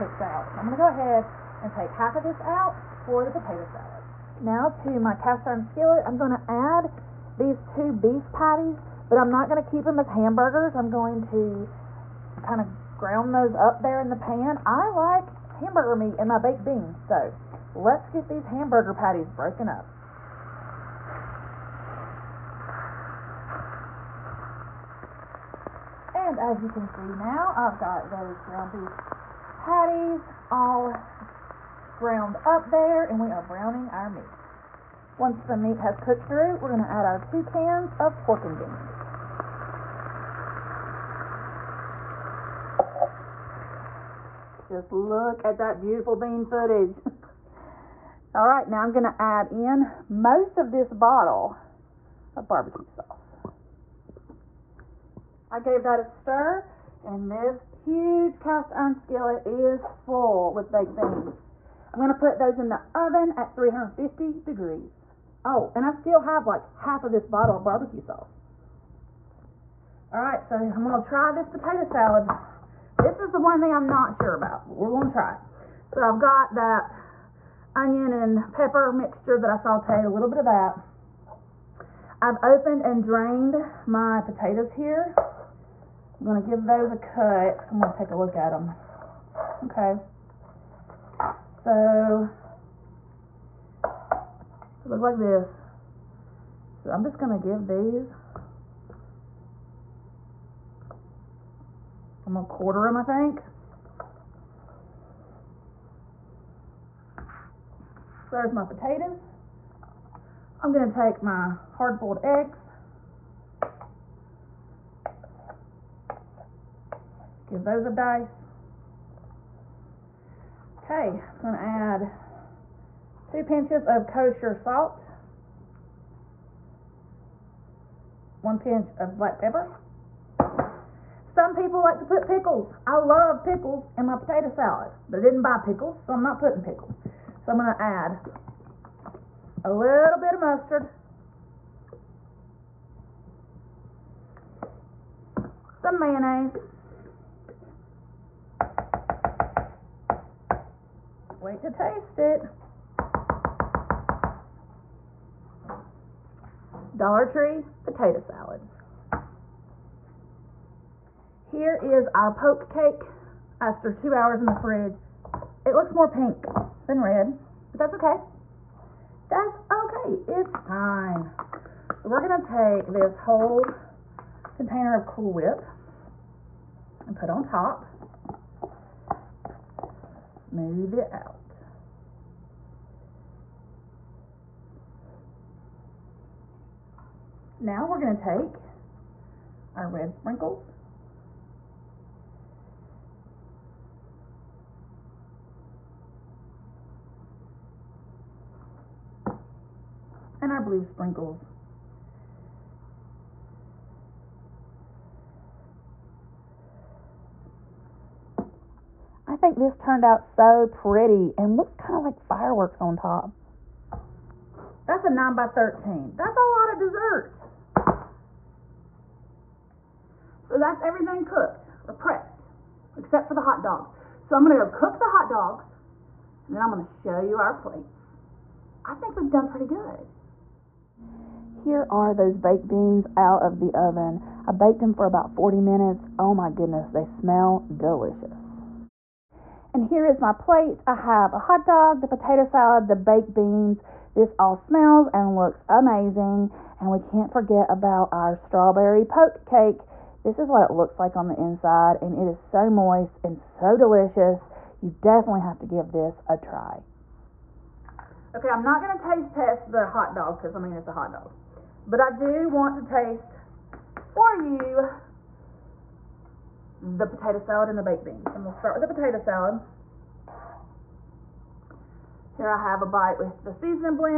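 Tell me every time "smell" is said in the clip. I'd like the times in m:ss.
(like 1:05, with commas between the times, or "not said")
3:57, 4:04.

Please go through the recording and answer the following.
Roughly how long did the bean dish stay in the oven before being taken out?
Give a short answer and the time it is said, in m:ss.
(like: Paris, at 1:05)
40 minutes, at 3:55.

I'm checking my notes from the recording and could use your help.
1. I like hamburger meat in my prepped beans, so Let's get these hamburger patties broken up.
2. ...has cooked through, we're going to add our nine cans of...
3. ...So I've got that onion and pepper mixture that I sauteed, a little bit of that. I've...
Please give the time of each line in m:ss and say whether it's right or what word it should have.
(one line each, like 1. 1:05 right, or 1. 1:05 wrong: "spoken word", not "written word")
1. 0:14 wrong: "baked", not "prepped"
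2. 0:35 wrong: "two", not "nine"
3. 1:15 right.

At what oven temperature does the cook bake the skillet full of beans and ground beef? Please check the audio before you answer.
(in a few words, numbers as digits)
350 degrees.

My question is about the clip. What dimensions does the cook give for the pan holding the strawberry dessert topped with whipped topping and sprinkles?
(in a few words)
9 by 13.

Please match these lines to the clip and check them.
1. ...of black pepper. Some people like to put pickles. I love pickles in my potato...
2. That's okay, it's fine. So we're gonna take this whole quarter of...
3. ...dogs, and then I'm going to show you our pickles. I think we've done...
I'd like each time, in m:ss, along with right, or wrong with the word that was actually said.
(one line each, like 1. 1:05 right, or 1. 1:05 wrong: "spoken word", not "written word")
1. 2:08 right
2. 2:49 wrong: "container", not "quarter"
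3. 3:45 wrong: "plates", not "pickles".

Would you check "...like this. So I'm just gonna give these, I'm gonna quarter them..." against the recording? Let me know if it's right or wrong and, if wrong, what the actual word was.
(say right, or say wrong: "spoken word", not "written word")
right.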